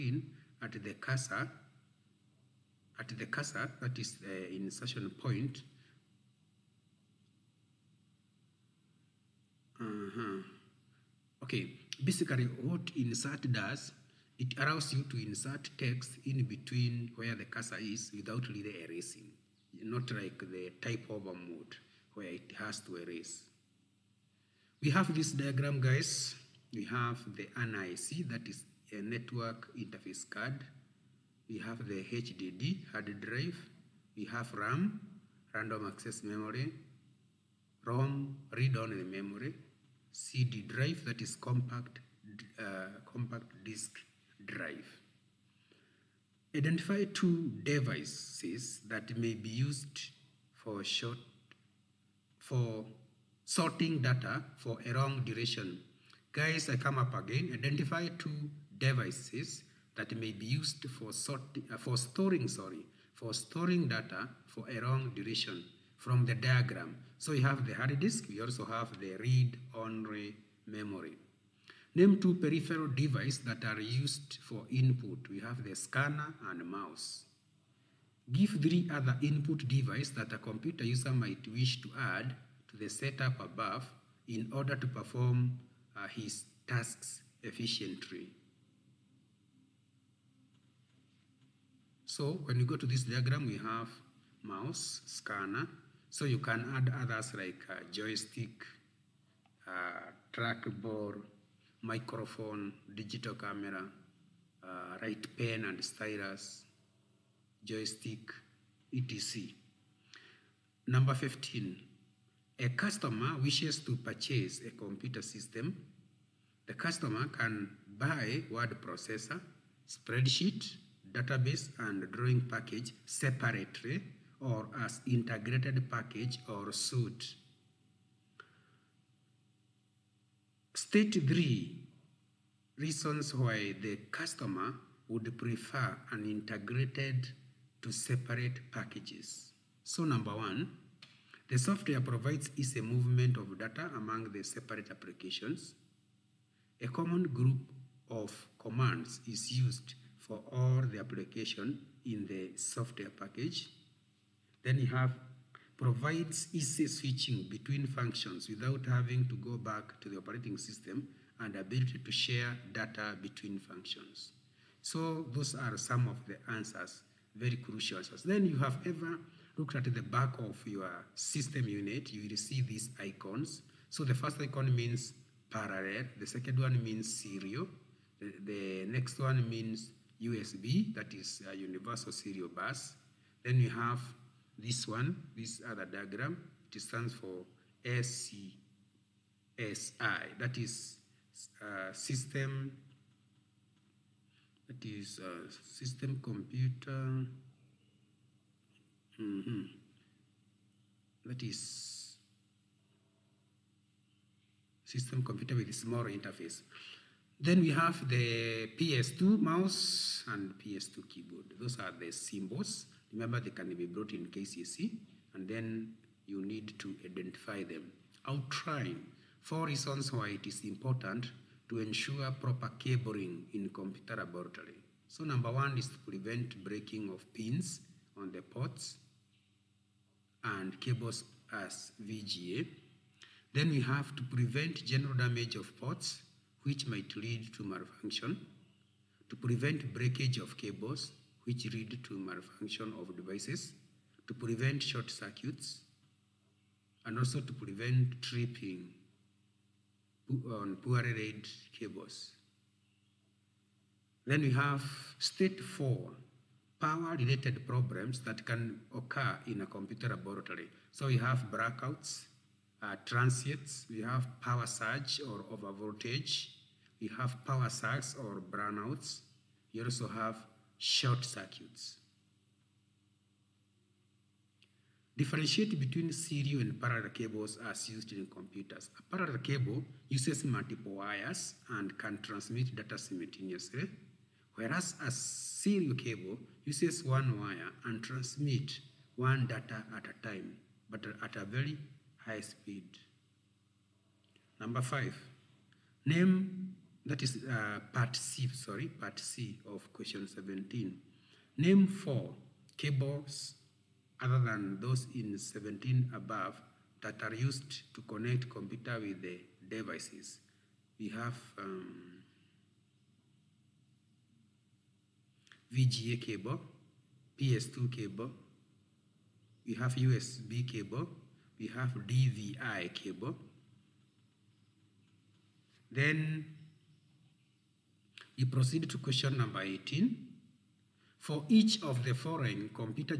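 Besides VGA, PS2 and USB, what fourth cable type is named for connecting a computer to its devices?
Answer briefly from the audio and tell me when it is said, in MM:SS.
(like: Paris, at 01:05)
DVI cable, at 05:21.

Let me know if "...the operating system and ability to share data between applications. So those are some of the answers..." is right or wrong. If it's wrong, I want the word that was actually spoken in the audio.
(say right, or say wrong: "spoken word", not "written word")
wrong: "functions", not "applications".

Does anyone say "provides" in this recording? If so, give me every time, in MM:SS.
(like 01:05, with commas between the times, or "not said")
02:21, 02:35.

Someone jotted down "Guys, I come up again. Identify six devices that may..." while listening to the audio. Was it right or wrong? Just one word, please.
wrong.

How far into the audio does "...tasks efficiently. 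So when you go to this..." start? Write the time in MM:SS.
01:26.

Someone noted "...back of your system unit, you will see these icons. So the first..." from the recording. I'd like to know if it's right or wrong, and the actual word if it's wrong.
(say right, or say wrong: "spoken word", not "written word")
right.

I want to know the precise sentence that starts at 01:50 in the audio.
Number 15, a customer wishes to purchase a computer system.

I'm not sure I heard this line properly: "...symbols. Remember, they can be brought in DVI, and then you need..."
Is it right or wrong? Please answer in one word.
wrong.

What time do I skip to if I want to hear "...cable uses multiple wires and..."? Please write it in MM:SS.
04:39.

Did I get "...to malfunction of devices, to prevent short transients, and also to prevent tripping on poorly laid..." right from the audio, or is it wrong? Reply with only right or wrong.
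wrong.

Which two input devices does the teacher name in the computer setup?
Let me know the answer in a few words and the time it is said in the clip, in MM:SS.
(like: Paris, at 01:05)
scanner and mouse, at 01:15.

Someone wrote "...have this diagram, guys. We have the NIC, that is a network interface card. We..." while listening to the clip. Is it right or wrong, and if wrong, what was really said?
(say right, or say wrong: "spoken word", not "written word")
right.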